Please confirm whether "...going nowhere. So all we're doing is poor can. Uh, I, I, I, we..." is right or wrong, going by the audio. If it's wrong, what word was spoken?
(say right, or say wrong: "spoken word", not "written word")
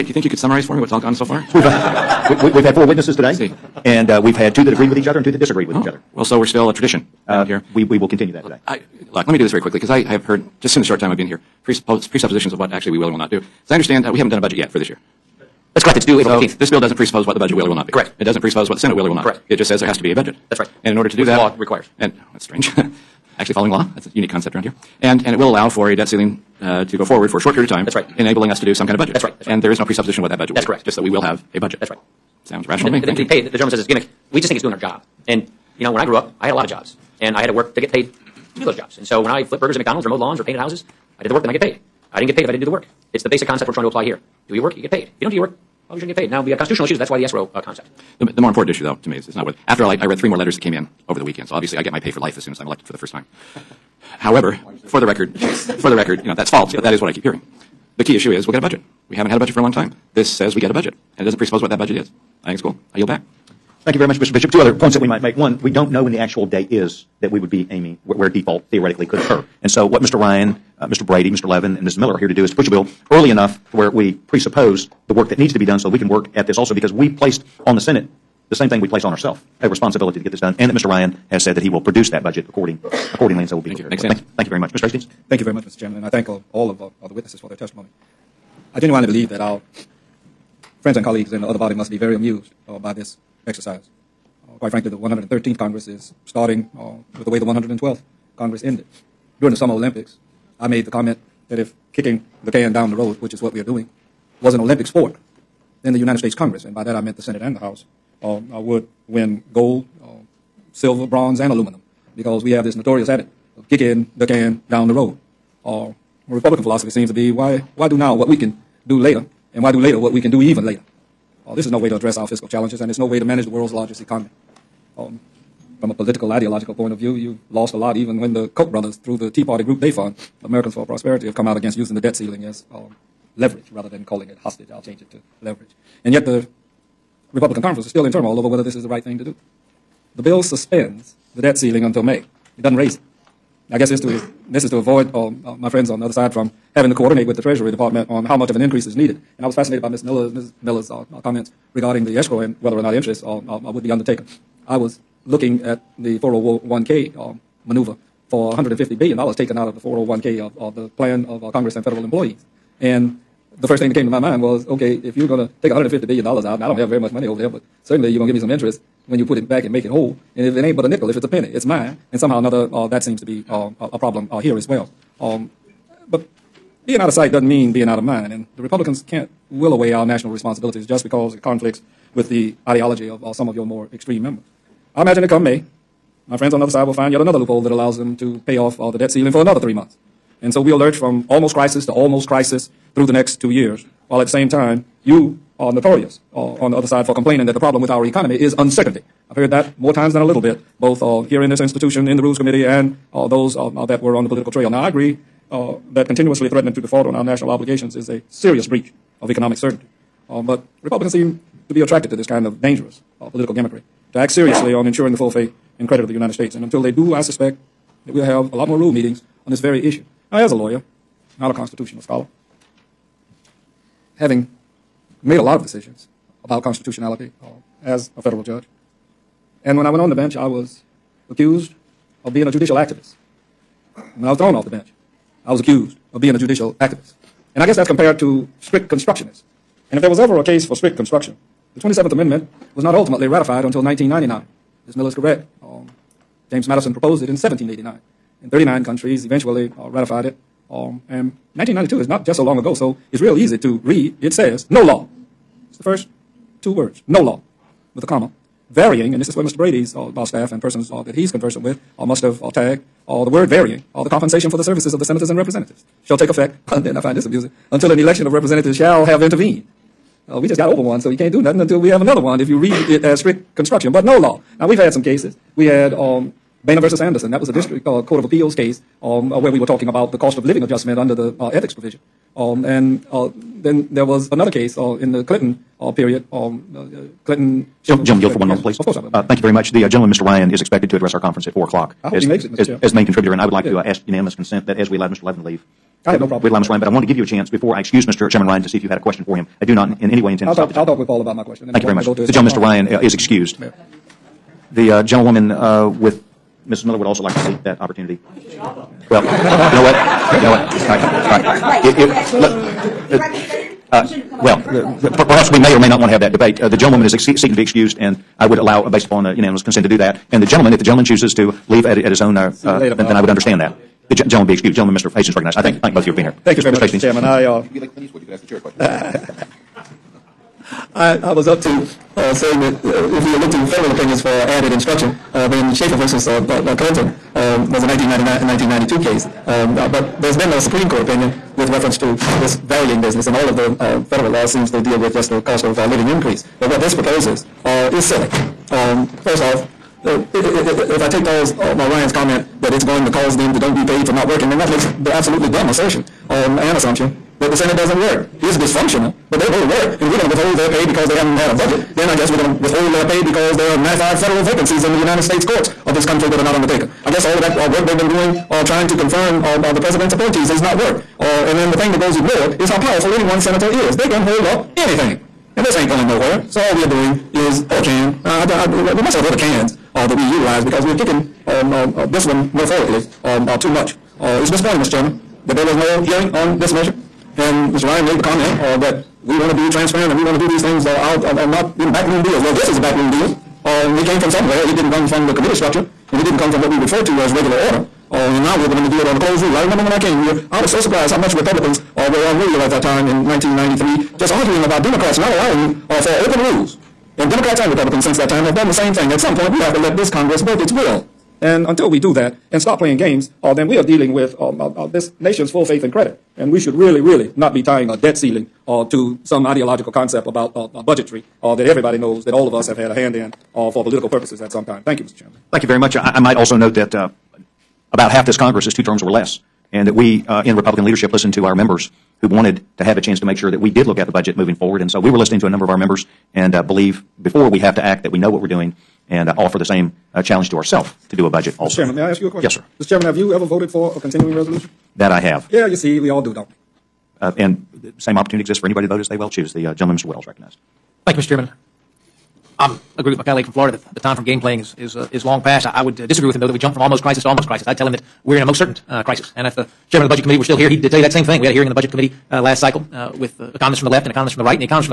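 right.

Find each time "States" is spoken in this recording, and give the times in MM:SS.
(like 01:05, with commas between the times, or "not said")
01:46, 03:36, 06:05.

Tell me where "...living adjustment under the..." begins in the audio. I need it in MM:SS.
04:40.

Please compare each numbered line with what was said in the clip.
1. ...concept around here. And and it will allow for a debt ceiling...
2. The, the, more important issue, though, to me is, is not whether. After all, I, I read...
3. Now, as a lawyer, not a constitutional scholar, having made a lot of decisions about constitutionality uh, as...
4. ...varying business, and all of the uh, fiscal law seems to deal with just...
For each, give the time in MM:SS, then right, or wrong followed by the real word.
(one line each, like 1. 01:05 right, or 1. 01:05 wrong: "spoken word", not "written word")
1. 00:24 right
2. 00:48 right
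3. 03:40 right
4. 05:42 wrong: "federal", not "fiscal".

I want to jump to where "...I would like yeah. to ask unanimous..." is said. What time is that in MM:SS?
04:53.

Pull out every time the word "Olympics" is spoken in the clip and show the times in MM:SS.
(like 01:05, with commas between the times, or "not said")
01:39, 01:44.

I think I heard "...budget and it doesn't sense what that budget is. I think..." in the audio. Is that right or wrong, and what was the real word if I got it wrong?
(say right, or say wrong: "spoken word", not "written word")
wrong: "presuppose", not "sense".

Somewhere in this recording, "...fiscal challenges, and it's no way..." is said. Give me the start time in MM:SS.
02:02.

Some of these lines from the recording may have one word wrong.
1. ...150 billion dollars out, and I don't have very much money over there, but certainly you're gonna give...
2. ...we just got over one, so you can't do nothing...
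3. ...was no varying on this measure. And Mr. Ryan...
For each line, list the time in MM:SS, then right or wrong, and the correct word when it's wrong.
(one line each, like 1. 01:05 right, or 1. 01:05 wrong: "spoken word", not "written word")
1. 02:45 right
2. 04:30 right
3. 06:25 wrong: "hearing", not "varying".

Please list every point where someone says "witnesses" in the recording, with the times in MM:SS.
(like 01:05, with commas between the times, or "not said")
00:02, 01:27.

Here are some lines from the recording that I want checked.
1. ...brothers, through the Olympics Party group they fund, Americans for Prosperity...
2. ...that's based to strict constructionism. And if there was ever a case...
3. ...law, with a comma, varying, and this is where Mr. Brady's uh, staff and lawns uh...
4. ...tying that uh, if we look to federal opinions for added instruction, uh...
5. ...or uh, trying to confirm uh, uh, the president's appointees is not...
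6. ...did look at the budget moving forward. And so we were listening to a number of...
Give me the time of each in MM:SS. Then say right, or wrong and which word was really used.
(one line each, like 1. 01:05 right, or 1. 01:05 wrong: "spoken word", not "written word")
1. 02:08 wrong: "Tea", not "Olympics"
2. 03:57 wrong: "compared", not "based"
3. 04:17 wrong: "persons", not "lawns"
4. 05:32 wrong: "saying", not "tying"
5. 06:08 right
6. 07:13 right.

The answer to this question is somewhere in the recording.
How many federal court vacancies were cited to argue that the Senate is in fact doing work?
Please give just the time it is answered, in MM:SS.
06:03.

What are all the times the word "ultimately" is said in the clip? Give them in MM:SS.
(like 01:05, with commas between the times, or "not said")
04:02.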